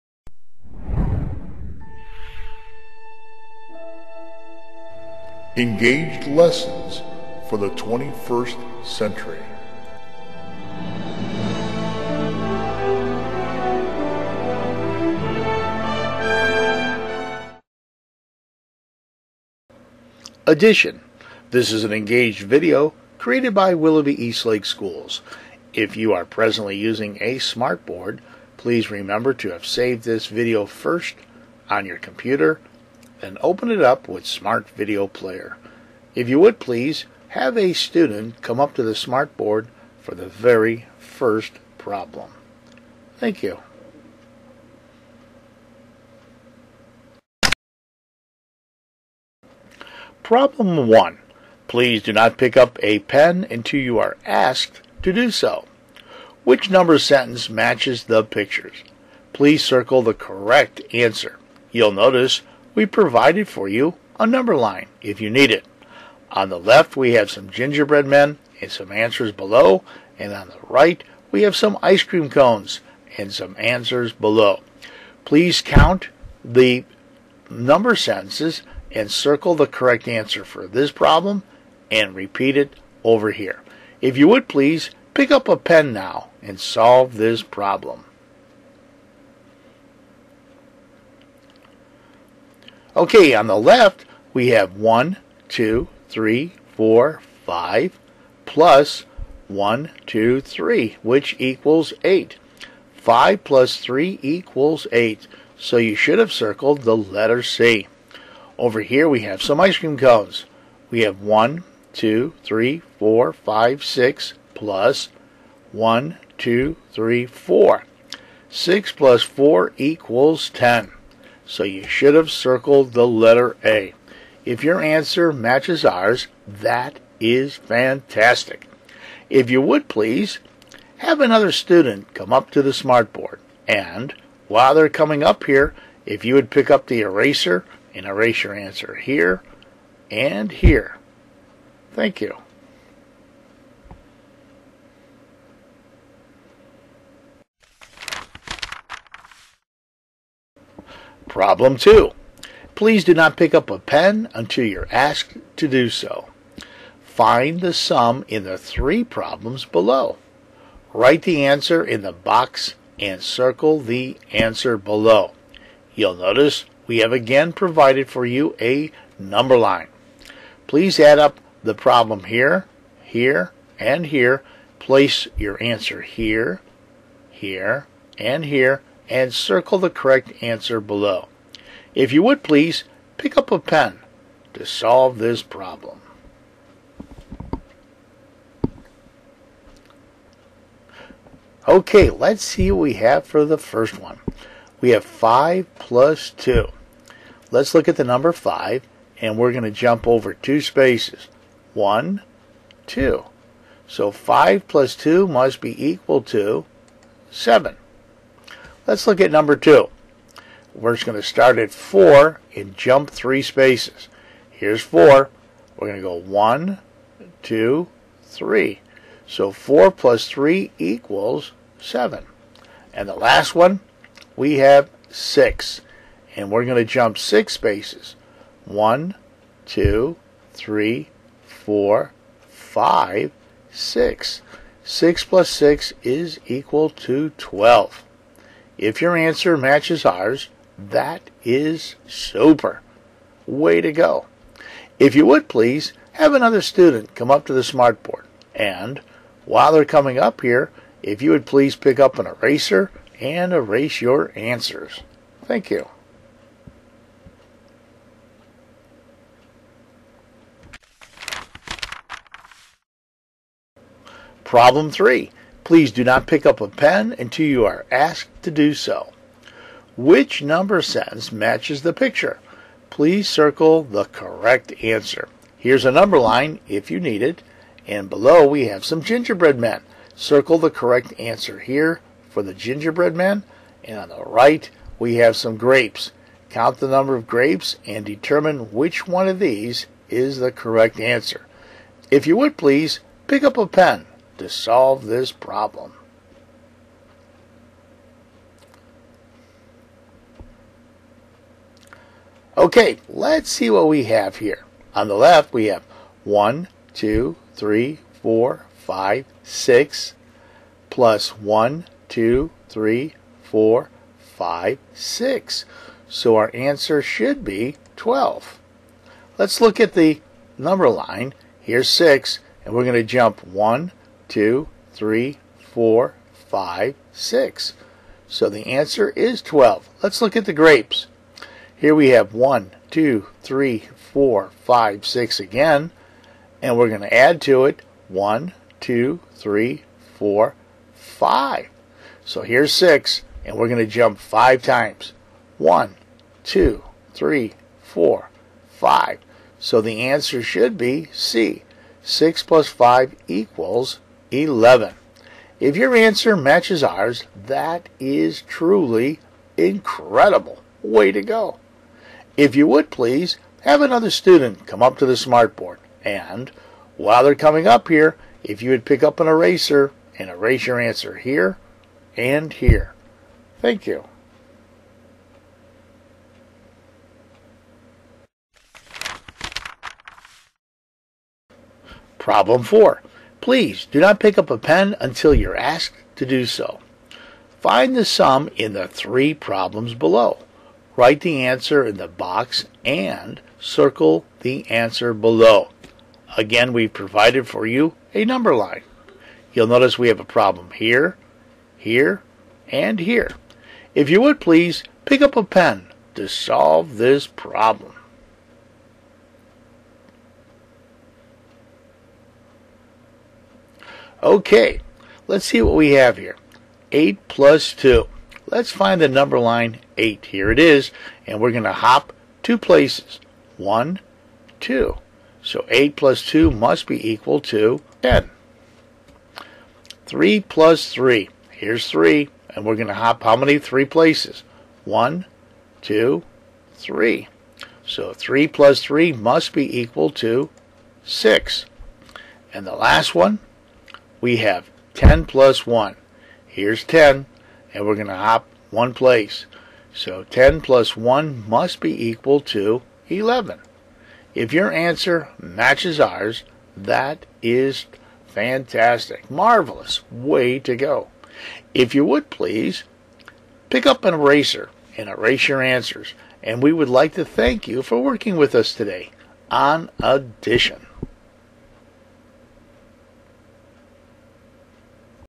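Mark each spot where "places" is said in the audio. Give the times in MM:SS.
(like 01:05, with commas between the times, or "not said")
02:54, 07:02, 07:13, 07:28.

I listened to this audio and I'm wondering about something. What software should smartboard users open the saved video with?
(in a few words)
Smart Video Player.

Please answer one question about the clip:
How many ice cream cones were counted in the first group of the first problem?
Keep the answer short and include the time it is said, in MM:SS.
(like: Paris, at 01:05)
6, at 01:58.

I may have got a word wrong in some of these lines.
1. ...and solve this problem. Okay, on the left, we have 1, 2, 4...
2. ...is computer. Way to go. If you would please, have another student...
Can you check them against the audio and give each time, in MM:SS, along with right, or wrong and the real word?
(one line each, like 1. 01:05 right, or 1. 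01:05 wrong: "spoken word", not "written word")
1. 01:26 wrong: "3", not "4"
2. 04:01 wrong: "super", not "computer".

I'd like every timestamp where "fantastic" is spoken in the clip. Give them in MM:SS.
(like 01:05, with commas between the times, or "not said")
02:07, 07:38.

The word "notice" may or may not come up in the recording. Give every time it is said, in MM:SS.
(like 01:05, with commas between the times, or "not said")
01:01, 02:46, 06:39.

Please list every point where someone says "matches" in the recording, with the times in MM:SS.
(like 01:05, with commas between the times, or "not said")
00:57, 02:05, 03:59, 04:31, 05:56, 07:35.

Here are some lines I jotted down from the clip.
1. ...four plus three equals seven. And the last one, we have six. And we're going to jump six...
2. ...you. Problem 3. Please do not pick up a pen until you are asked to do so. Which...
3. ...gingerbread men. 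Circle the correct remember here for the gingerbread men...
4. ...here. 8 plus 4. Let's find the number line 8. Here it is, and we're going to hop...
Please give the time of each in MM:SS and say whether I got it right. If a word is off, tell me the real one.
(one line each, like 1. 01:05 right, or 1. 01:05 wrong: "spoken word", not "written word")
1. 03:39 right
2. 04:15 right
3. 04:39 wrong: "answer", not "remember"
4. 06:56 wrong: "2", not "4".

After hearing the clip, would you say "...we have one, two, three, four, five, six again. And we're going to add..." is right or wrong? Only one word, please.
right.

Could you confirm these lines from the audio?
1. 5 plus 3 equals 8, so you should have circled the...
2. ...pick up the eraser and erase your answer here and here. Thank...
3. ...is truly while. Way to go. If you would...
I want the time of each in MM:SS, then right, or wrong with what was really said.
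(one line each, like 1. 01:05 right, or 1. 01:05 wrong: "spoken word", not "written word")
1. 01:42 right
2. 02:16 right
3. 05:57 wrong: "incredible", not "while".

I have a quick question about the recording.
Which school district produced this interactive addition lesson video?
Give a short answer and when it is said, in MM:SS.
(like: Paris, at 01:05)
Willoughby Eastlake Schools, at 00:23.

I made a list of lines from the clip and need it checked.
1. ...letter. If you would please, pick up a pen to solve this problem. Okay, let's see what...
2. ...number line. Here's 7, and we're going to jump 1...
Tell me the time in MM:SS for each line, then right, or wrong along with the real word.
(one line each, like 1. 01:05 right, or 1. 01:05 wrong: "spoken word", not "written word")
1. 04:50 wrong: "answer", not "letter"
2. 05:20 wrong: "6", not "7".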